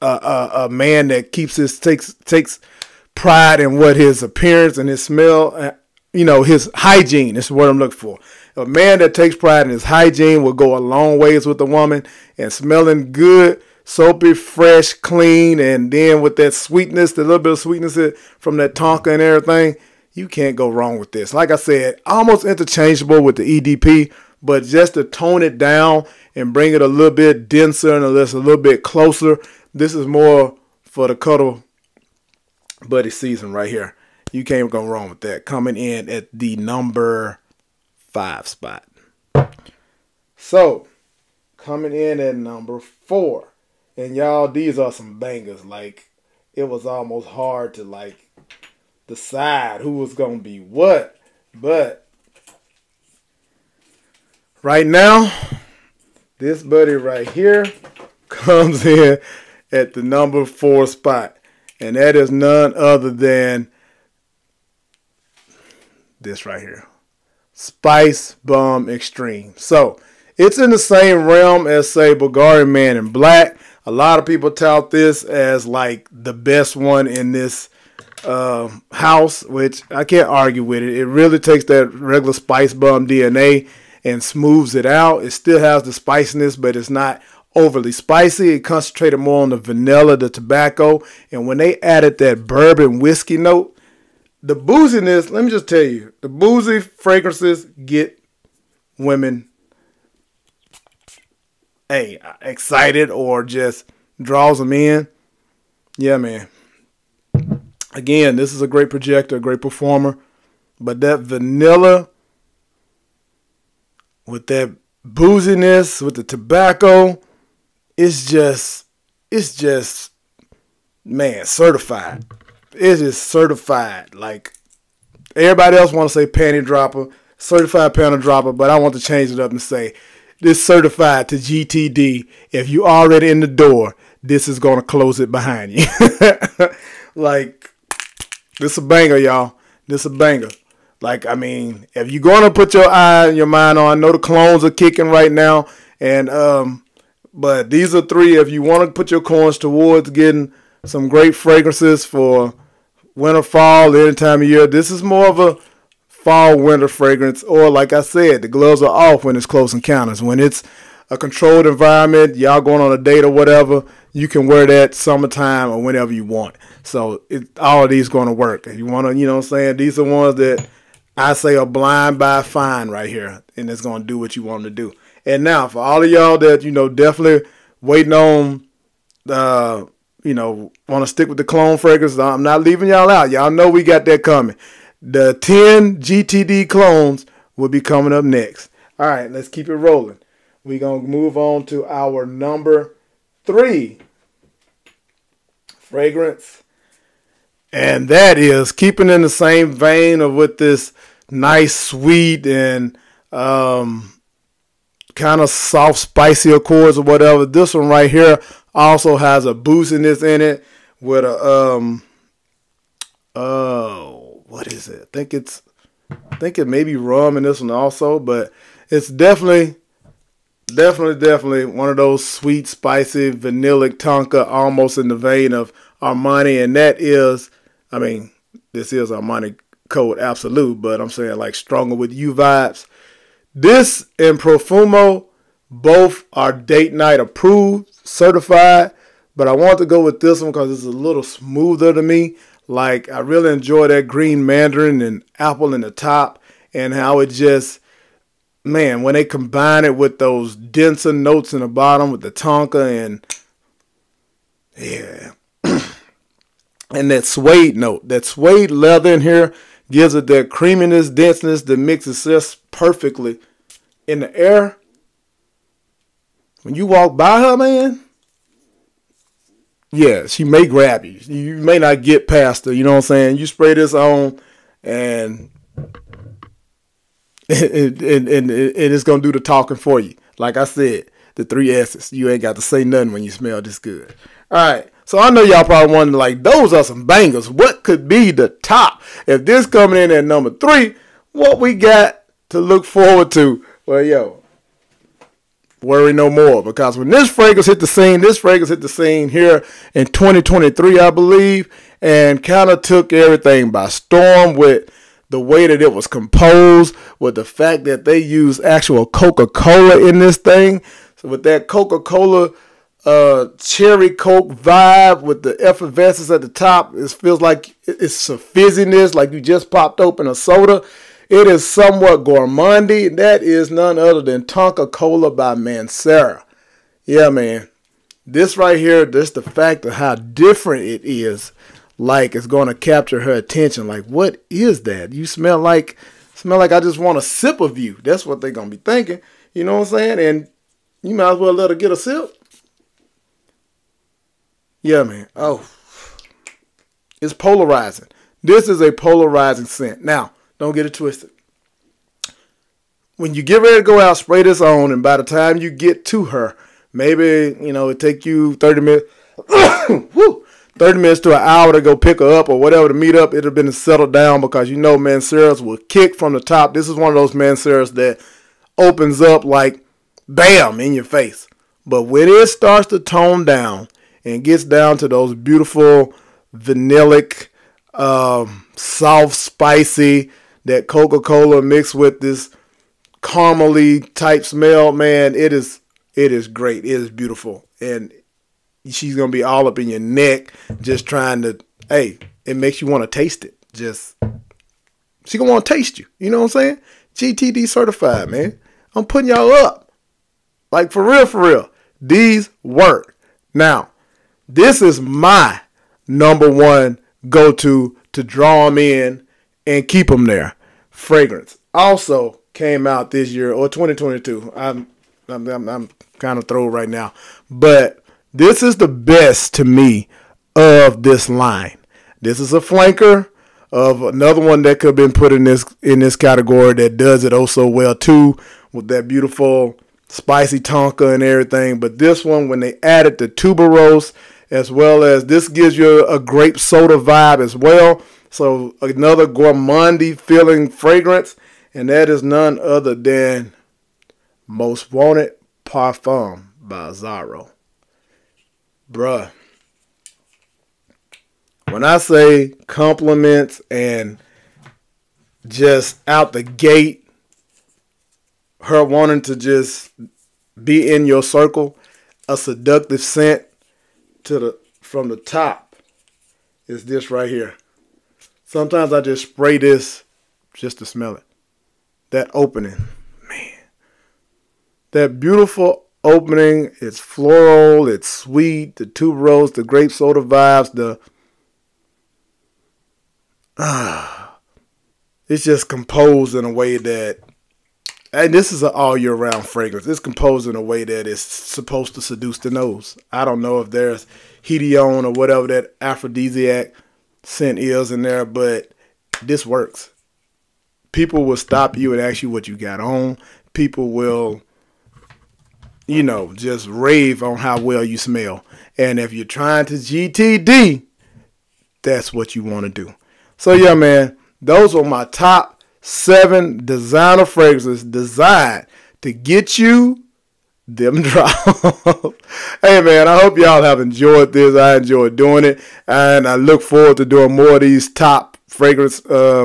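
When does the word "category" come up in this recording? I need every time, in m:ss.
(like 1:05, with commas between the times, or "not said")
7:06.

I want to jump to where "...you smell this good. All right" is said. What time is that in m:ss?
4:43.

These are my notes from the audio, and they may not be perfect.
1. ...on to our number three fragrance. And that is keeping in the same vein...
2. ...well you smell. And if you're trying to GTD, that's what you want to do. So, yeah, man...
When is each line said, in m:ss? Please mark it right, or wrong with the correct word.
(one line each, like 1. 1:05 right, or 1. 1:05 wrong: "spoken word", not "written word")
1. 3:11 right
2. 8:27 right.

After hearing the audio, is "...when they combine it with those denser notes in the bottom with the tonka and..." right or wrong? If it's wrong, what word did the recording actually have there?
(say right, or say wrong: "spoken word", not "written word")
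right.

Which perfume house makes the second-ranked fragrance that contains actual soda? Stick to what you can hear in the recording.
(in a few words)
Mancera.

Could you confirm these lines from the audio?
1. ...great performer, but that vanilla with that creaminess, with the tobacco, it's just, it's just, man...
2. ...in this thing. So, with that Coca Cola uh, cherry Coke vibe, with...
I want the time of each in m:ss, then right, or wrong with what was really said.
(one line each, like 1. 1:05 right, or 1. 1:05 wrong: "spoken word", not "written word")
1. 1:49 wrong: "booziness", not "creaminess"
2. 5:10 right.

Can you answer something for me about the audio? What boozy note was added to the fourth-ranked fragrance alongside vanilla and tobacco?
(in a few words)
bourbon whiskey.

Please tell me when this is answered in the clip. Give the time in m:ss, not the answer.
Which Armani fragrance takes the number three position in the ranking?
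3:49.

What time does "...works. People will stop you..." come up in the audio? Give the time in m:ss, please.
8:19.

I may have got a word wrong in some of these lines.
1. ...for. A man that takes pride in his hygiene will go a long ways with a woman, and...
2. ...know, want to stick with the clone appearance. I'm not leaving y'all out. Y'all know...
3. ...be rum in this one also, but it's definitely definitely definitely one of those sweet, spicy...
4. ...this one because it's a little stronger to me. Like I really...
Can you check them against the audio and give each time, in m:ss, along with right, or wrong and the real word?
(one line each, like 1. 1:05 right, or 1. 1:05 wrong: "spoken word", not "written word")
1. 0:07 right
2. 3:00 wrong: "fragrance", not "appearance"
3. 3:36 right
4. 4:00 wrong: "smoother", not "stronger".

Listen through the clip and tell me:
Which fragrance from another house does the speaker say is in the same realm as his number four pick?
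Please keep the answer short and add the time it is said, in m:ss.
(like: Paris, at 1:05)
Bulgari Man in Black, at 1:12.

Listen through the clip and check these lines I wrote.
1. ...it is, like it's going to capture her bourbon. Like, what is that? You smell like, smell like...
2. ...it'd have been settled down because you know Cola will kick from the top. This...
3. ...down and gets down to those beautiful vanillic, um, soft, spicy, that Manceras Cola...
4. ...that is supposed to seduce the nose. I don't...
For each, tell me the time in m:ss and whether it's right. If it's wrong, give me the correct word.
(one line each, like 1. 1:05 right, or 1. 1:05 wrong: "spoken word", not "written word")
1. 5:30 wrong: "attention", not "bourbon"
2. 6:03 wrong: "Manceras", not "Cola"
3. 6:13 wrong: "Coca", not "Manceras"
4. 8:10 right.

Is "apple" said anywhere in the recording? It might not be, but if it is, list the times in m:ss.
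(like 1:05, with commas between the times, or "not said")
4:05.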